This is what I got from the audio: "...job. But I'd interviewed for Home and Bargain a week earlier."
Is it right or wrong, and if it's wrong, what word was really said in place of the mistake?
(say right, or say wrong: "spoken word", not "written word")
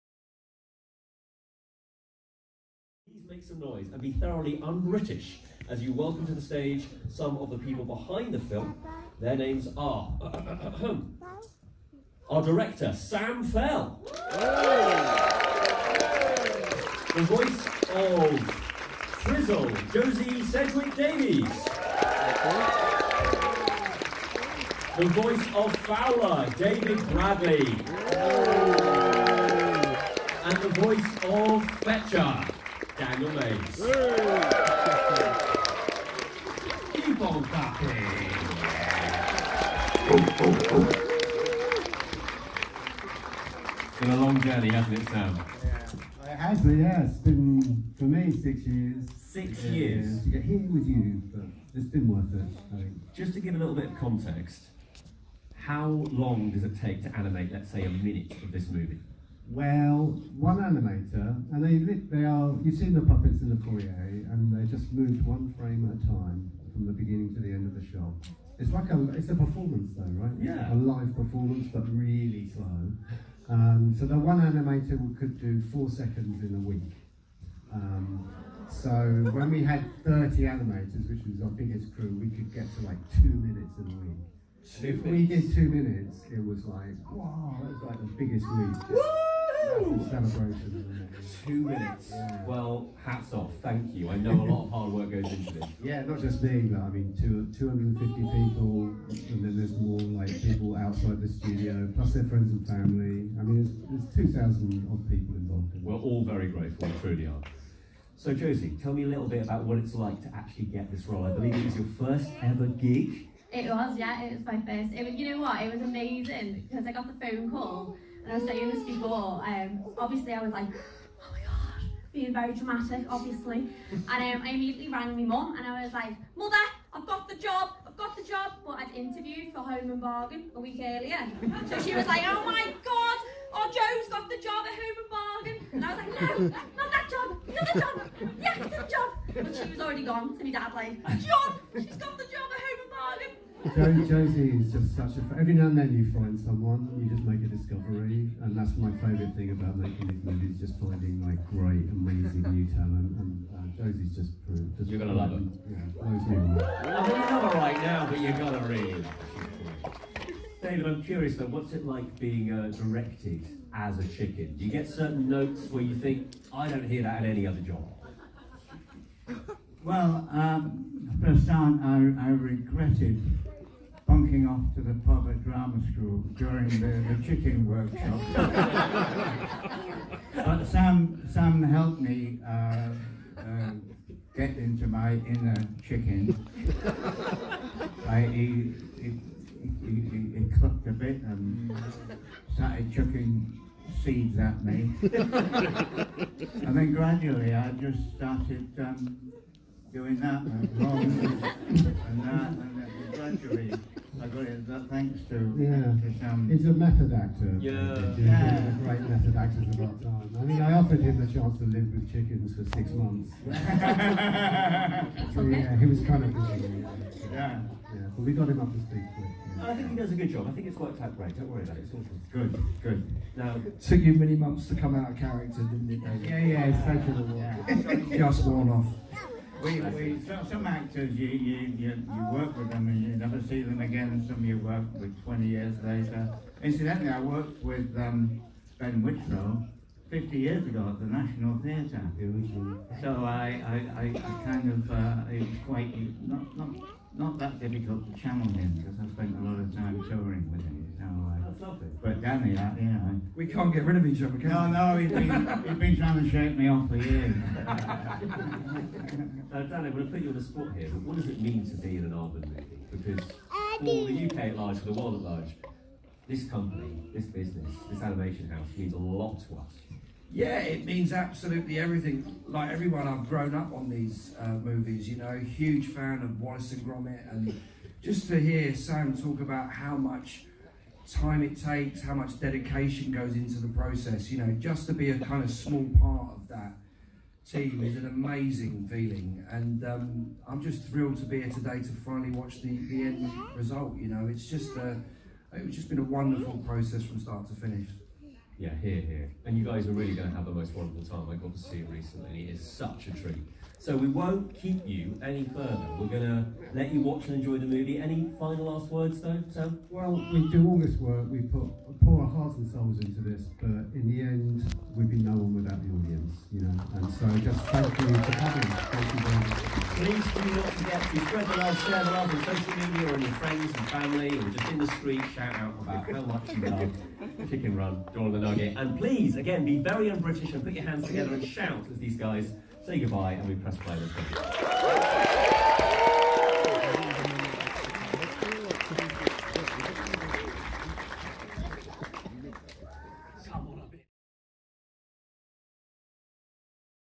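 right.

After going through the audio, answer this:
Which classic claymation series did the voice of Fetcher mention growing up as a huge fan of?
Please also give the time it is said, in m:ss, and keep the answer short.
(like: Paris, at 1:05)
Wallace and Gromit, at 4:36.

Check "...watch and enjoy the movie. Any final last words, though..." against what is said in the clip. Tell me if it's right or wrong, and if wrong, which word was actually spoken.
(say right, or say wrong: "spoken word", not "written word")
right.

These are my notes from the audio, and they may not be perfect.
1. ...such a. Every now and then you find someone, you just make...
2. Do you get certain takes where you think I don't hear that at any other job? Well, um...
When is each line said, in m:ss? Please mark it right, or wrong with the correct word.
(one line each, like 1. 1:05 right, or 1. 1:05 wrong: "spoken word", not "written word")
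1. 2:24 right
2. 2:44 wrong: "notes", not "takes".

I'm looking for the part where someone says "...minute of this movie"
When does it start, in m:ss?
0:57.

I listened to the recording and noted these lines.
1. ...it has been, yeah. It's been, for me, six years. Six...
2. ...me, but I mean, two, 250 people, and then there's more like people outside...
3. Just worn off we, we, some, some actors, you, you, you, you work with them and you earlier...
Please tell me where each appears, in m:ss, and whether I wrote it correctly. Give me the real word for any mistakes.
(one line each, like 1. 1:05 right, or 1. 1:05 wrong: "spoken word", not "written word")
1. 0:46 right
2. 1:36 right
3. 3:48 wrong: "never", not "earlier".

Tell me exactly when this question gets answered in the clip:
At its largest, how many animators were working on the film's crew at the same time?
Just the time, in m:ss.
1:20.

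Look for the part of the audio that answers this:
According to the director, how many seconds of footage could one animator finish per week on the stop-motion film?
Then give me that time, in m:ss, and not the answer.
1:15.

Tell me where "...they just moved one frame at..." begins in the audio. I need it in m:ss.
1:04.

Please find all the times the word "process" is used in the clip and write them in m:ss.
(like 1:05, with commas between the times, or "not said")
4:43, 4:56.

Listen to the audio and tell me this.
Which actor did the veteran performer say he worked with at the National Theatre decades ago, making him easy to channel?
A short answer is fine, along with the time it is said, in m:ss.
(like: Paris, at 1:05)
Ben Whitrow, at 3:58.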